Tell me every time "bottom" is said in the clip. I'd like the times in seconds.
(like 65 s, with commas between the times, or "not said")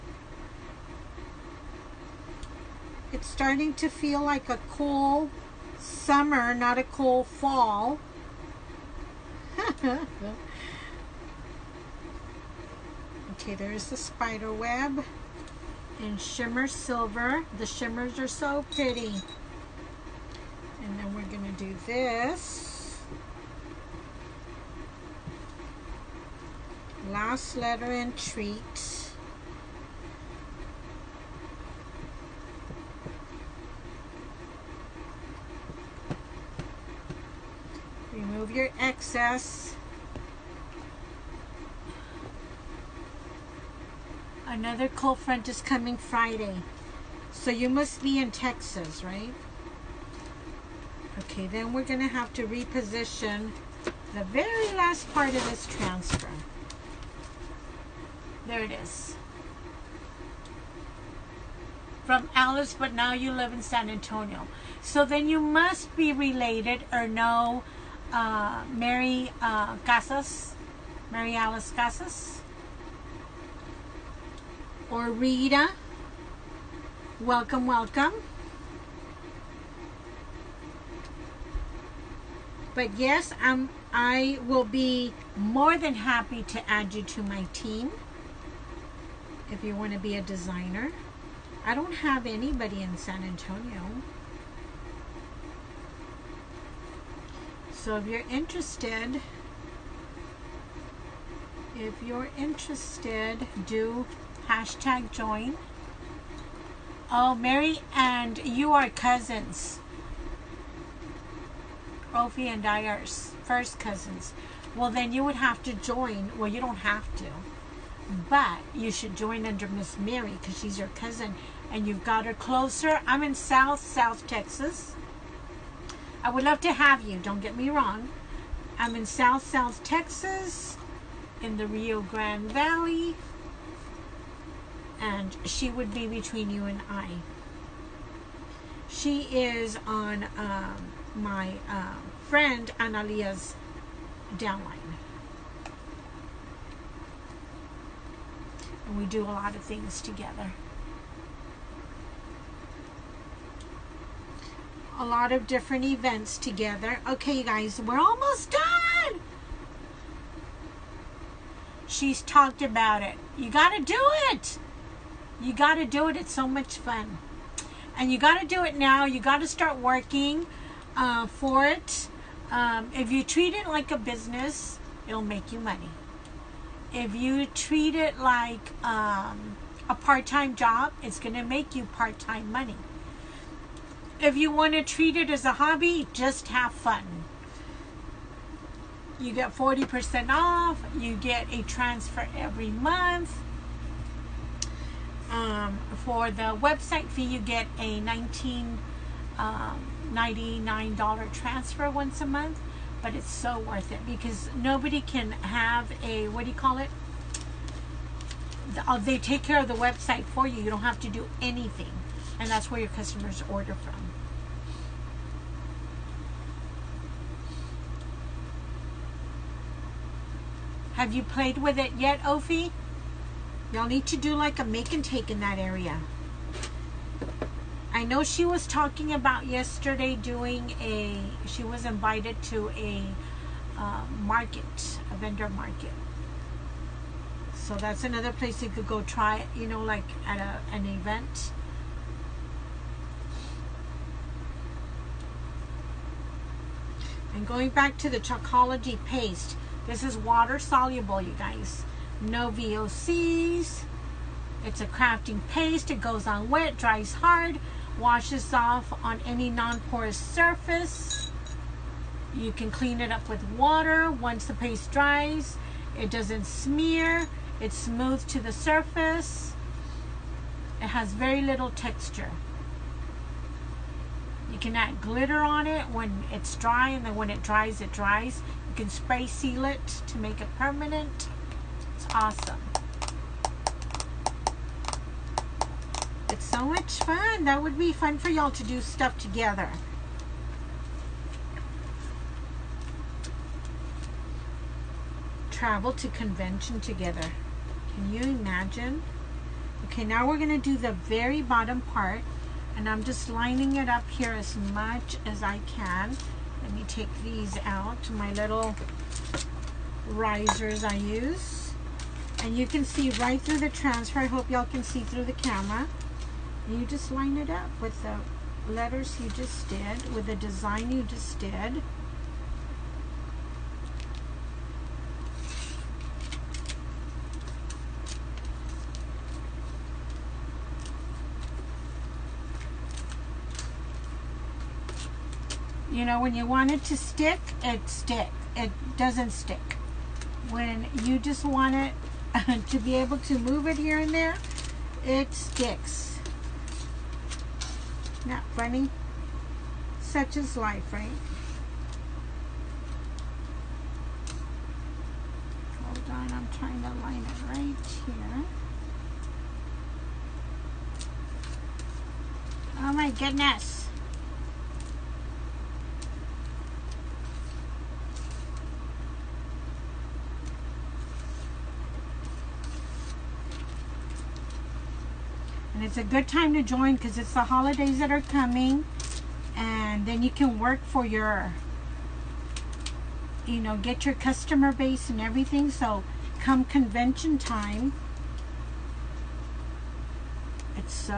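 301 s.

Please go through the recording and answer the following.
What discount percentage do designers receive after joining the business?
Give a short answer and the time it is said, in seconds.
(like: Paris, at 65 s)
40%, at 189 s.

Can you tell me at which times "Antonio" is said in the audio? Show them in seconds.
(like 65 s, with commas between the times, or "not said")
63 s, 93 s.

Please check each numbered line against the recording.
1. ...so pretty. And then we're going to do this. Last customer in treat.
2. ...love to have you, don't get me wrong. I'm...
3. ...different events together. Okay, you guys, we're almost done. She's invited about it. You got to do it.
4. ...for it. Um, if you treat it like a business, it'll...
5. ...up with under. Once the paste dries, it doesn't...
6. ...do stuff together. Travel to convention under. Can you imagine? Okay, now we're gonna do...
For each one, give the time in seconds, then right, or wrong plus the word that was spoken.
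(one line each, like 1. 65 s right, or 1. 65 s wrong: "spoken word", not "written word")
1. 18 s wrong: "letter", not "customer"
2. 126 s right
3. 155 s wrong: "talked", not "invited"
4. 171 s right
5. 263 s wrong: "water", not "under"
6. 288 s wrong: "together", not "under".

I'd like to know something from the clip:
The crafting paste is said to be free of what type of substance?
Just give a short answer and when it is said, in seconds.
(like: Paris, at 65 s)
VOCs, at 252 s.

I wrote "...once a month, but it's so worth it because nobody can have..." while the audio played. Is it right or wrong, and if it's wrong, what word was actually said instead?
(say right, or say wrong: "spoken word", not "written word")
right.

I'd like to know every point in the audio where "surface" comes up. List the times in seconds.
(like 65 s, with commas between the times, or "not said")
260 s, 268 s.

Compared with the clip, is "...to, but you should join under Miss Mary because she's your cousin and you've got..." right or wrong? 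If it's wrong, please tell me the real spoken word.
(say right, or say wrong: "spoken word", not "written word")
right.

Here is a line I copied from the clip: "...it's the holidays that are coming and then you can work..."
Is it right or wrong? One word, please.
right.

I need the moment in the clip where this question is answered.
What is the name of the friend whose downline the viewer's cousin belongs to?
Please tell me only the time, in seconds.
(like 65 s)
142 s.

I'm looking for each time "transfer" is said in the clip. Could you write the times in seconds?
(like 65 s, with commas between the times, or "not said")
55 s, 191 s, 201 s, 313 s.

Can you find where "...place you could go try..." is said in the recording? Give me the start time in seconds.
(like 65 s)
238 s.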